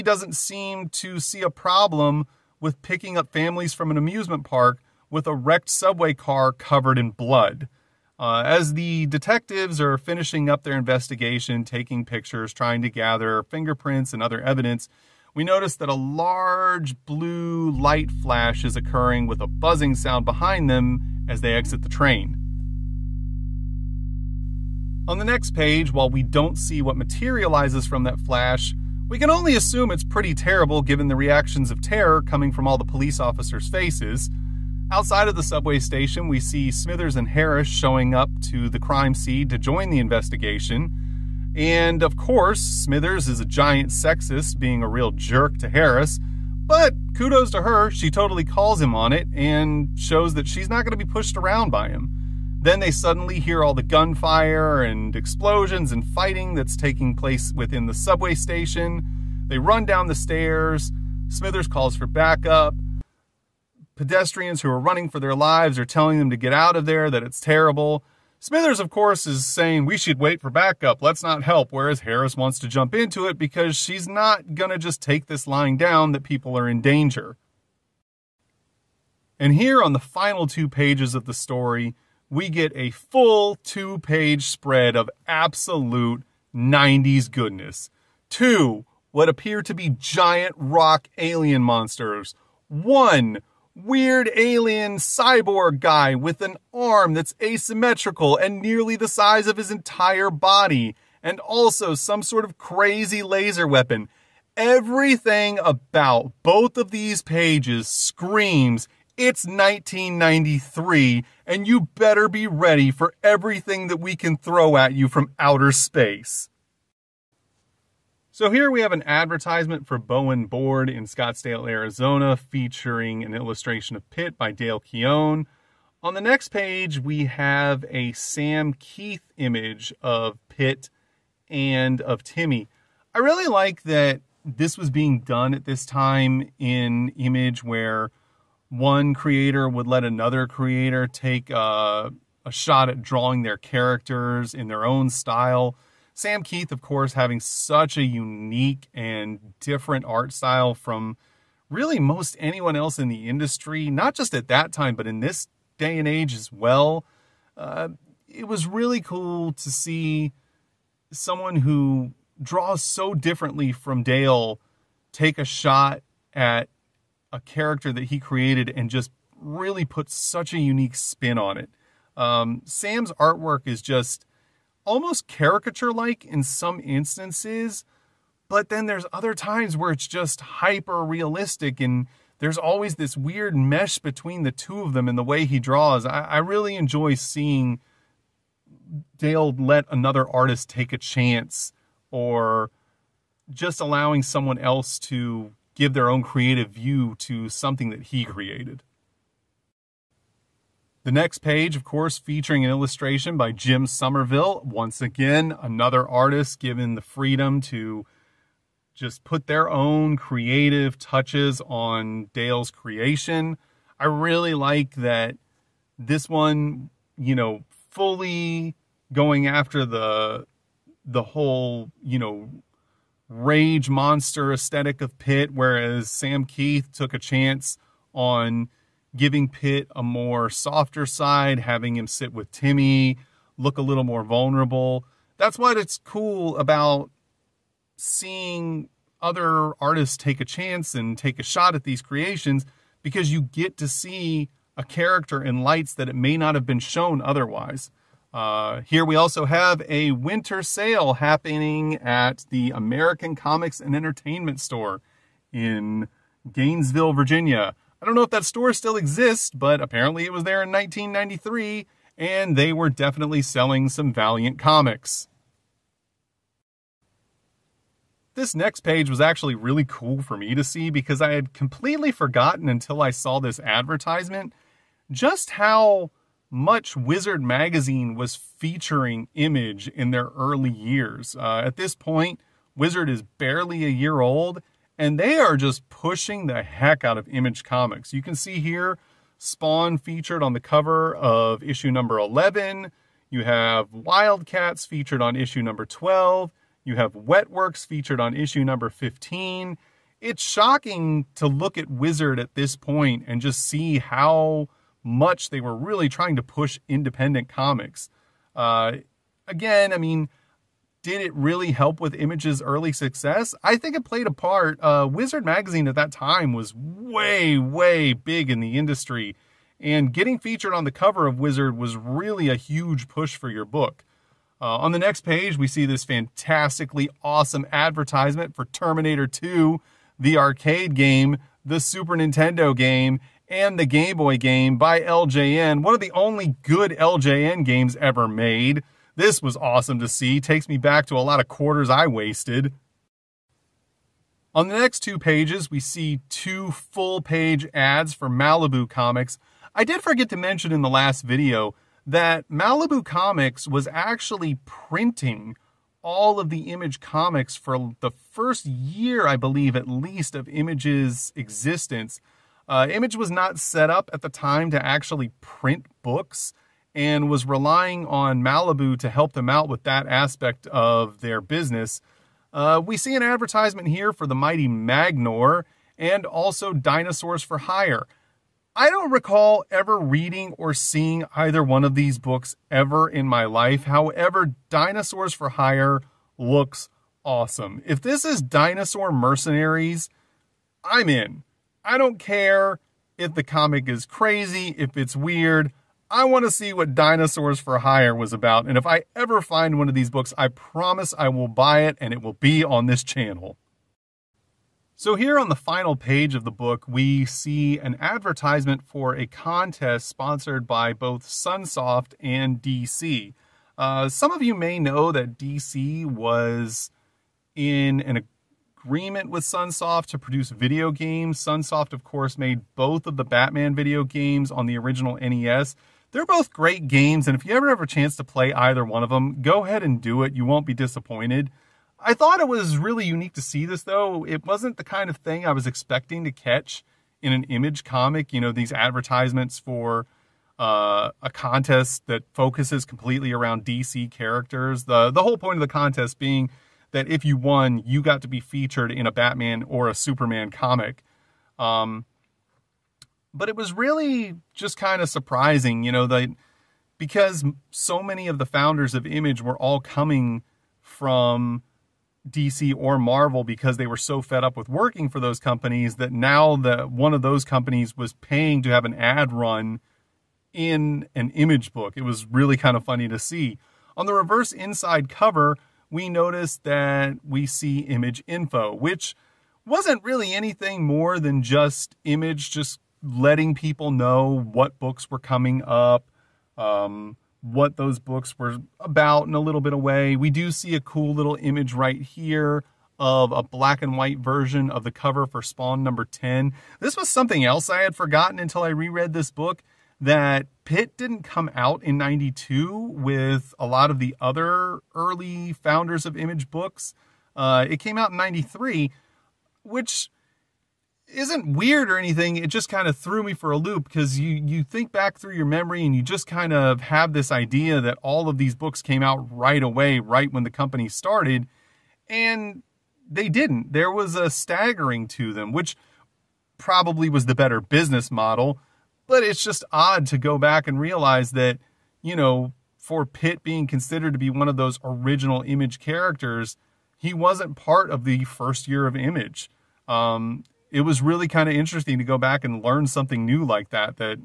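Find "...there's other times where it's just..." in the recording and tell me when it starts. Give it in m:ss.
2:58.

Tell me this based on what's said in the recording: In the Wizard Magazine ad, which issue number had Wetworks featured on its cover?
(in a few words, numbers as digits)
15.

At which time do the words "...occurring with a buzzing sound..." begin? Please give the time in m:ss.
0:18.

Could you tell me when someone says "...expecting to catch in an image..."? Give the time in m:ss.
7:15.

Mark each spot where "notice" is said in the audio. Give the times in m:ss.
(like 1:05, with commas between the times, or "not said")
0:15, 7:56.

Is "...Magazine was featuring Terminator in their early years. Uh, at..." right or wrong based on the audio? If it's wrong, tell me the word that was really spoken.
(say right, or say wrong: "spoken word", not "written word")
wrong: "Image", not "Terminator".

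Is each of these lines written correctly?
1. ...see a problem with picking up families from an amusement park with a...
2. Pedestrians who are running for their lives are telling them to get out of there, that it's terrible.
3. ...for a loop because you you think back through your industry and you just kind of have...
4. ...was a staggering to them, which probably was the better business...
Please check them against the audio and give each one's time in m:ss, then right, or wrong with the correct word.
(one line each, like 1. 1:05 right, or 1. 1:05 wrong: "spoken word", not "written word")
1. 0:01 right
2. 1:03 right
3. 8:33 wrong: "memory", not "industry"
4. 8:43 right.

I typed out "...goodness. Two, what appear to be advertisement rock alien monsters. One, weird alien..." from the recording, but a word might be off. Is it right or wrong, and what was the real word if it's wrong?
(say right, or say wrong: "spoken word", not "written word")
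wrong: "giant", not "advertisement".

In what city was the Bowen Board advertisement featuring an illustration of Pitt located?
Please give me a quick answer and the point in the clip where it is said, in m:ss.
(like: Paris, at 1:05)
Scottsdale, Arizona, at 2:01.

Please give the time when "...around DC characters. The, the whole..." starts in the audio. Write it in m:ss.
7:23.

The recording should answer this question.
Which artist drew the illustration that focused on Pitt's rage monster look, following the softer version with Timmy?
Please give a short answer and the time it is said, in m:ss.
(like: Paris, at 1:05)
Jim Somerville, at 3:23.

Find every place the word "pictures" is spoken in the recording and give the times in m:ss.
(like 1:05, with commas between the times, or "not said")
0:12.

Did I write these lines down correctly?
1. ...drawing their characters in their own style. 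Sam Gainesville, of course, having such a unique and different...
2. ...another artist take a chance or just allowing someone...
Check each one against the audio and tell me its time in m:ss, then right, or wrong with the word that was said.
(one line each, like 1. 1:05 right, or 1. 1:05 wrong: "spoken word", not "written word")
1. 2:23 wrong: "Kieth", not "Gainesville"
2. 3:09 right.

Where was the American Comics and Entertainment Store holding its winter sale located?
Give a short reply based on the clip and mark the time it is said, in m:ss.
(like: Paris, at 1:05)
Gainesville, Virginia, at 4:16.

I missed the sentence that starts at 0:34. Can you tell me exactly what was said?
Outside of the subway station, we see Smithers and Harris showing up to the crime scene to join the investigation.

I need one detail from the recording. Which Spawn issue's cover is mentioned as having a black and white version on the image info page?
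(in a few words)
10.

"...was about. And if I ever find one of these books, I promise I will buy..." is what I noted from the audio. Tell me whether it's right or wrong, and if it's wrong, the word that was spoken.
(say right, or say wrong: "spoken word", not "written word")
right.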